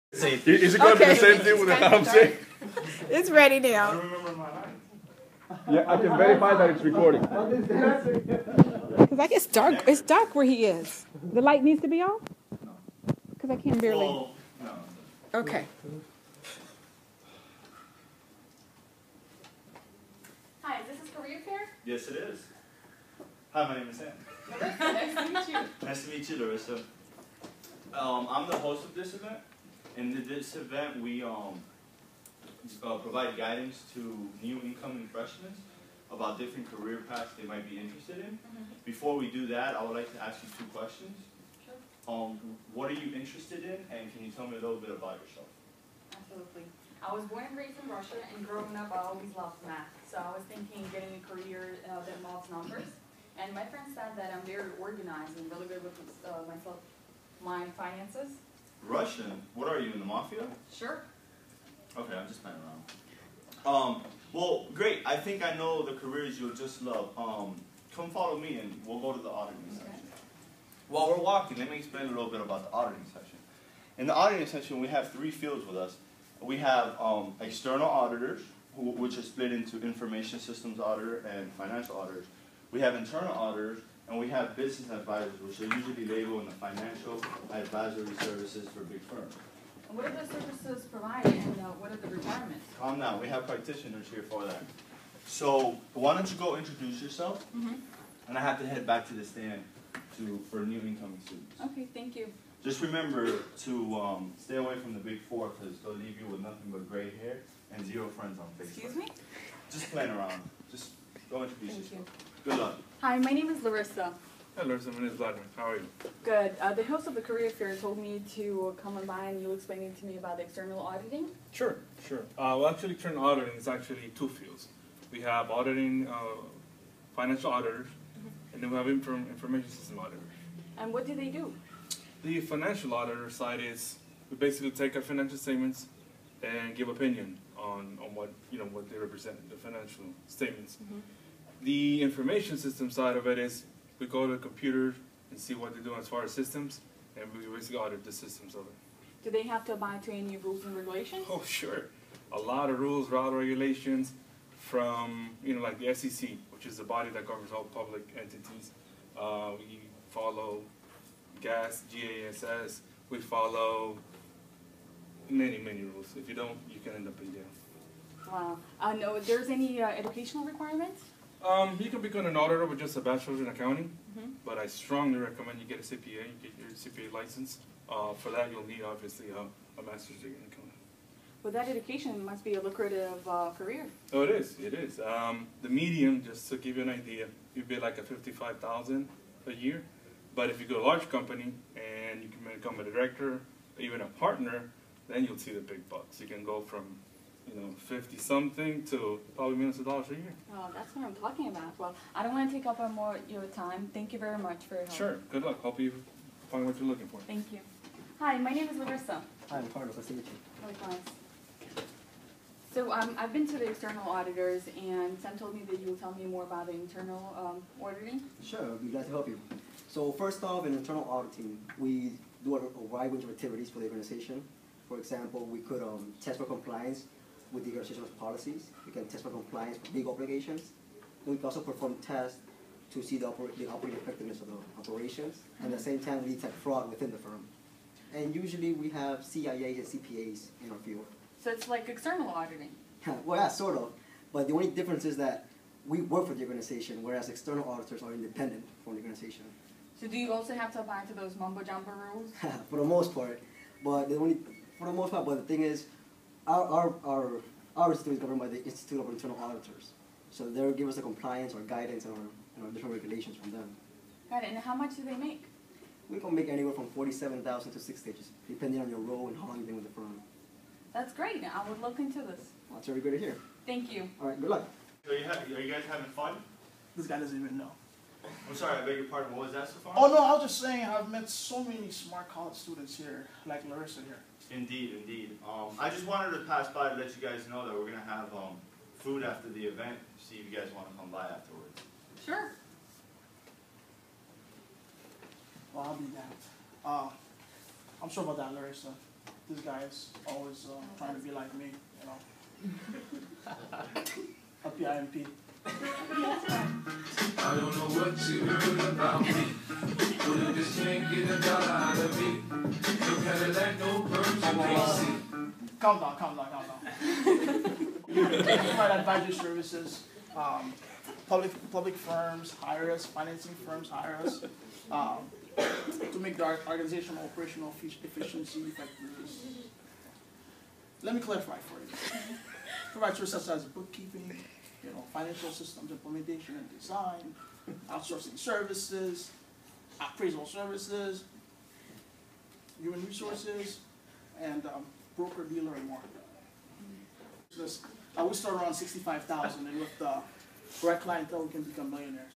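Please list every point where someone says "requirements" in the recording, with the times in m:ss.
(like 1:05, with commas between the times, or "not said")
1:32, 2:50.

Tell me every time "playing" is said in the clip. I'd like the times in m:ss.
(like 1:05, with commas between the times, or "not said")
1:02, 1:49.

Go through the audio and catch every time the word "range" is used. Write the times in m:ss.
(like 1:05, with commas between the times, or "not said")
3:43.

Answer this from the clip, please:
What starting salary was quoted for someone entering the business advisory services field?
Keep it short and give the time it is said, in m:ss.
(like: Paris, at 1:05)
$65,000, at 5:48.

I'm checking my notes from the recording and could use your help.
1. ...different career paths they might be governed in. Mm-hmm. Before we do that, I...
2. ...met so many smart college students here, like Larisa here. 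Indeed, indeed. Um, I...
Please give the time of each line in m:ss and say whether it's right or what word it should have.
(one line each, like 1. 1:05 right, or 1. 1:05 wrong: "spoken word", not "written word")
1. 0:36 wrong: "interested", not "governed"
2. 4:41 right.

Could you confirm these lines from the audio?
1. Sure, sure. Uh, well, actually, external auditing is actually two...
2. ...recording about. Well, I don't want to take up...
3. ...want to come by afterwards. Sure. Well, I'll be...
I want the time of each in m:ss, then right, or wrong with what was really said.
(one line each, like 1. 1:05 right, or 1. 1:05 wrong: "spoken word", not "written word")
1. 2:01 right
2. 3:21 wrong: "talking", not "recording"
3. 4:50 right.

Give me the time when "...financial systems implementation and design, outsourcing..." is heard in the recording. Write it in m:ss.
5:35.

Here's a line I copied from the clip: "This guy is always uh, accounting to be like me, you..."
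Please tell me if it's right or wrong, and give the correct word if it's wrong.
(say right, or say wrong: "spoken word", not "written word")
wrong: "trying", not "accounting".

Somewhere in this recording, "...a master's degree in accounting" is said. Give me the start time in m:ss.
2:59.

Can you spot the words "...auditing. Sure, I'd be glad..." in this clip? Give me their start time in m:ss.
3:37.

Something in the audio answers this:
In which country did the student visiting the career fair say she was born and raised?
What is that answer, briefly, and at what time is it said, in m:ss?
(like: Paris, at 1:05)
Russia, at 0:47.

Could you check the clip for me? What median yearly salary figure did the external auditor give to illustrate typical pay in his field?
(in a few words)
$55,000.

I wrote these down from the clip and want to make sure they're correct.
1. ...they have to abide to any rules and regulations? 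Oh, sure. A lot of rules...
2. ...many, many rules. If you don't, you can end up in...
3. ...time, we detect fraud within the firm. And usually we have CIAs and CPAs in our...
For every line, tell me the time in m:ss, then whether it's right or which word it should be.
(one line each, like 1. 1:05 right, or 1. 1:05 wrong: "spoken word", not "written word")
1. 2:29 right
2. 2:45 right
3. 3:55 right.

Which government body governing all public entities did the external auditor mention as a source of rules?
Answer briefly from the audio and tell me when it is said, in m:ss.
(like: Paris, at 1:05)
SEC, at 2:35.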